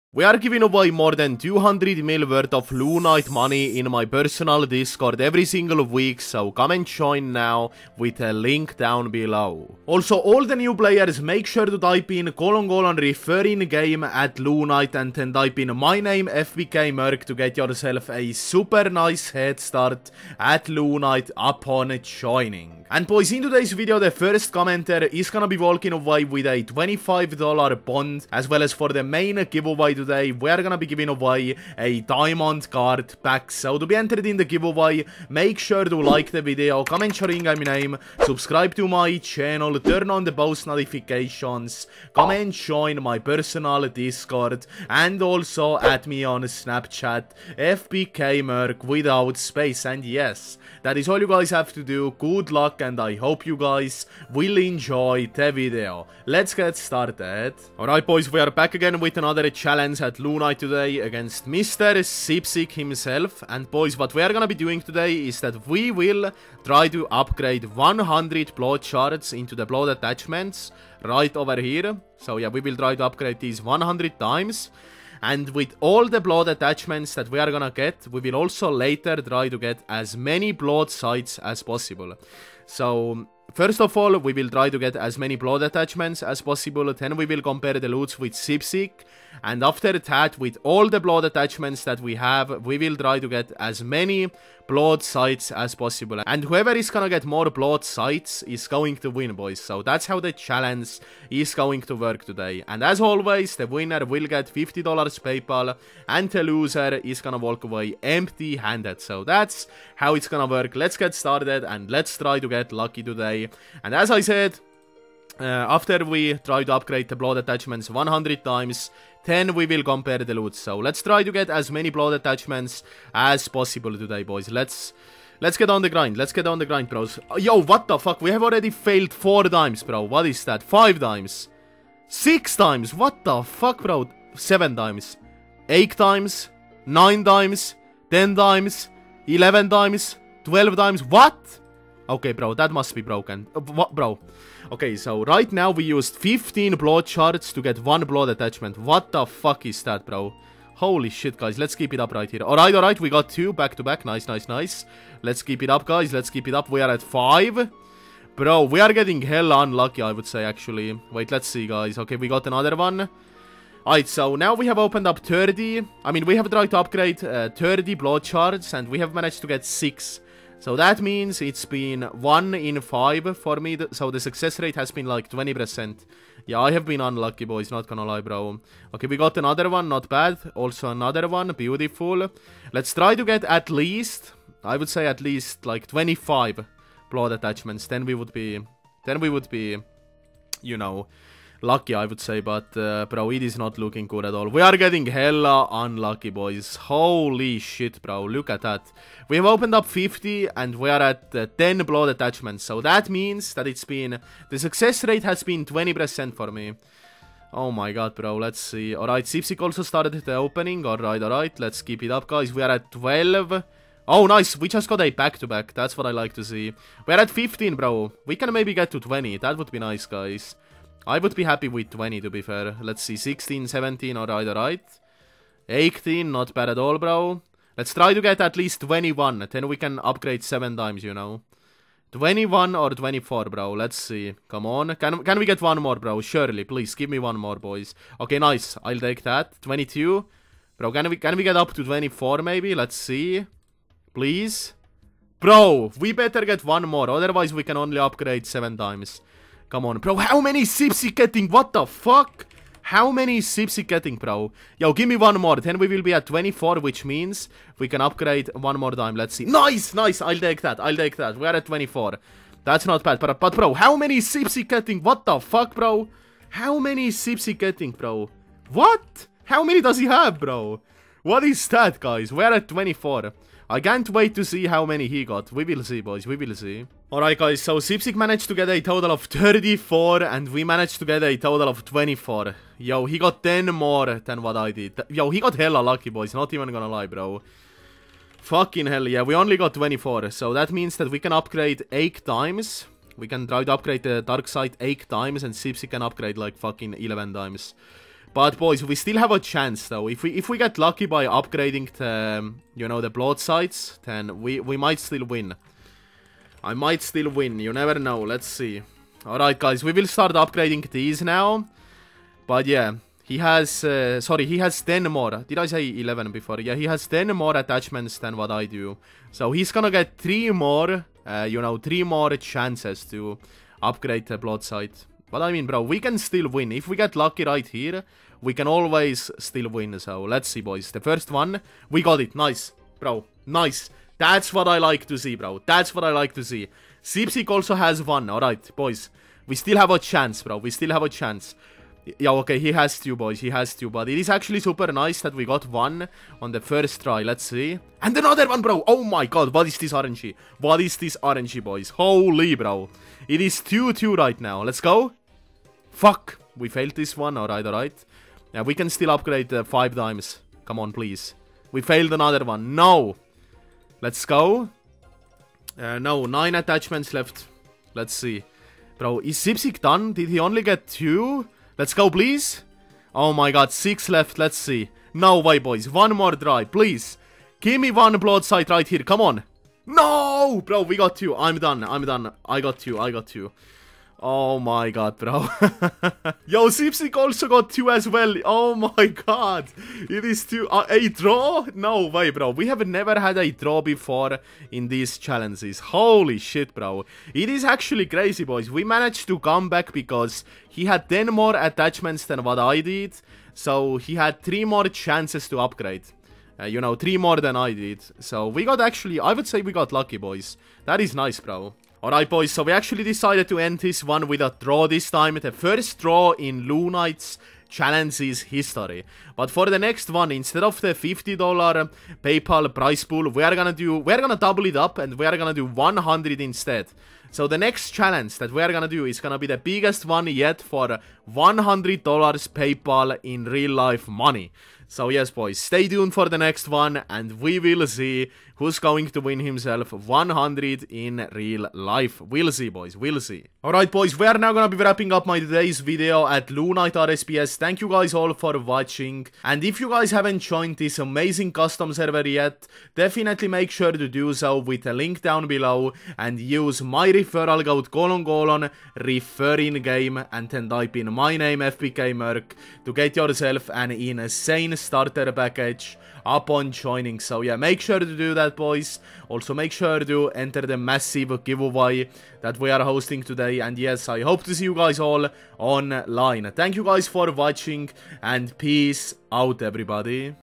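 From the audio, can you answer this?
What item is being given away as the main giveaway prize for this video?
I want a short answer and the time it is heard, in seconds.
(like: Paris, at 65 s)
Diamond card pack, at 32 s.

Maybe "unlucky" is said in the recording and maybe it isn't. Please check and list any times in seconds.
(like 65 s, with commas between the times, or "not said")
159 s, 177 s, 195 s.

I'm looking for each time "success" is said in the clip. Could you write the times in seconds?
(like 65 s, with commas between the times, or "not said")
174 s, 204 s.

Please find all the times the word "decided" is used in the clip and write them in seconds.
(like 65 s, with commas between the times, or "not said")
413 s.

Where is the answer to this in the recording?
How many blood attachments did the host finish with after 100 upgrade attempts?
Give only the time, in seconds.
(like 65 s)
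281 s.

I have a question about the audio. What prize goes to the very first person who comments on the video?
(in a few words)
$25 bond.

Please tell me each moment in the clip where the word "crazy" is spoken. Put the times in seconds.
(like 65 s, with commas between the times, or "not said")
398 s.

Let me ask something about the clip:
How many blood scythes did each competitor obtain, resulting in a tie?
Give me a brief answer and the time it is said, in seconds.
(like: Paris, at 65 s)
2, at 387 s.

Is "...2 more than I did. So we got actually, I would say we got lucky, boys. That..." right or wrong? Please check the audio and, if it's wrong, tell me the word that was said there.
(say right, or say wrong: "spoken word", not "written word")
wrong: "3", not "2".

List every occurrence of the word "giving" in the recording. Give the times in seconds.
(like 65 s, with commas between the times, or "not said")
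0 s, 30 s.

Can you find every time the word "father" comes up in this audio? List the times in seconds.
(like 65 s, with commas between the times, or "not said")
not said.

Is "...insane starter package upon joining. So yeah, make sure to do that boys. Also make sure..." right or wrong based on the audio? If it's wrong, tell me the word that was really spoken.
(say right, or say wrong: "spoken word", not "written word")
right.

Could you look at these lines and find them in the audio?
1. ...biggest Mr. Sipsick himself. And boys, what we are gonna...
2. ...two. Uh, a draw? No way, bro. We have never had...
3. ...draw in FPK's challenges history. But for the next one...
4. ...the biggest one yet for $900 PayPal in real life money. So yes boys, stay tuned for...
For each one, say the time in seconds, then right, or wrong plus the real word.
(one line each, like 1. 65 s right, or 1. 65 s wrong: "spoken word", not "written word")
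1. 60 s wrong: "against", not "biggest"
2. 390 s right
3. 415 s wrong: "Lunite", not "FPK"
4. 429 s wrong: "100", not "900".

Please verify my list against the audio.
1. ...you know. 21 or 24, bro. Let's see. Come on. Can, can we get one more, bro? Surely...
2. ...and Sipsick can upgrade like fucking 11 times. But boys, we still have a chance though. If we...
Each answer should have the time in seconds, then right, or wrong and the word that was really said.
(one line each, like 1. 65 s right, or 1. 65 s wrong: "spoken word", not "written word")
1. 231 s right
2. 295 s right.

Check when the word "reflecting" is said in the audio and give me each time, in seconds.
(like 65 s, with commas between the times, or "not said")
not said.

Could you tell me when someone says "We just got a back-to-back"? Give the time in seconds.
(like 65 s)
214 s.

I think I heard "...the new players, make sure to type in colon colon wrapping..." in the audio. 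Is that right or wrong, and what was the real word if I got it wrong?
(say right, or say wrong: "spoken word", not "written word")
wrong: "referring", not "wrapping".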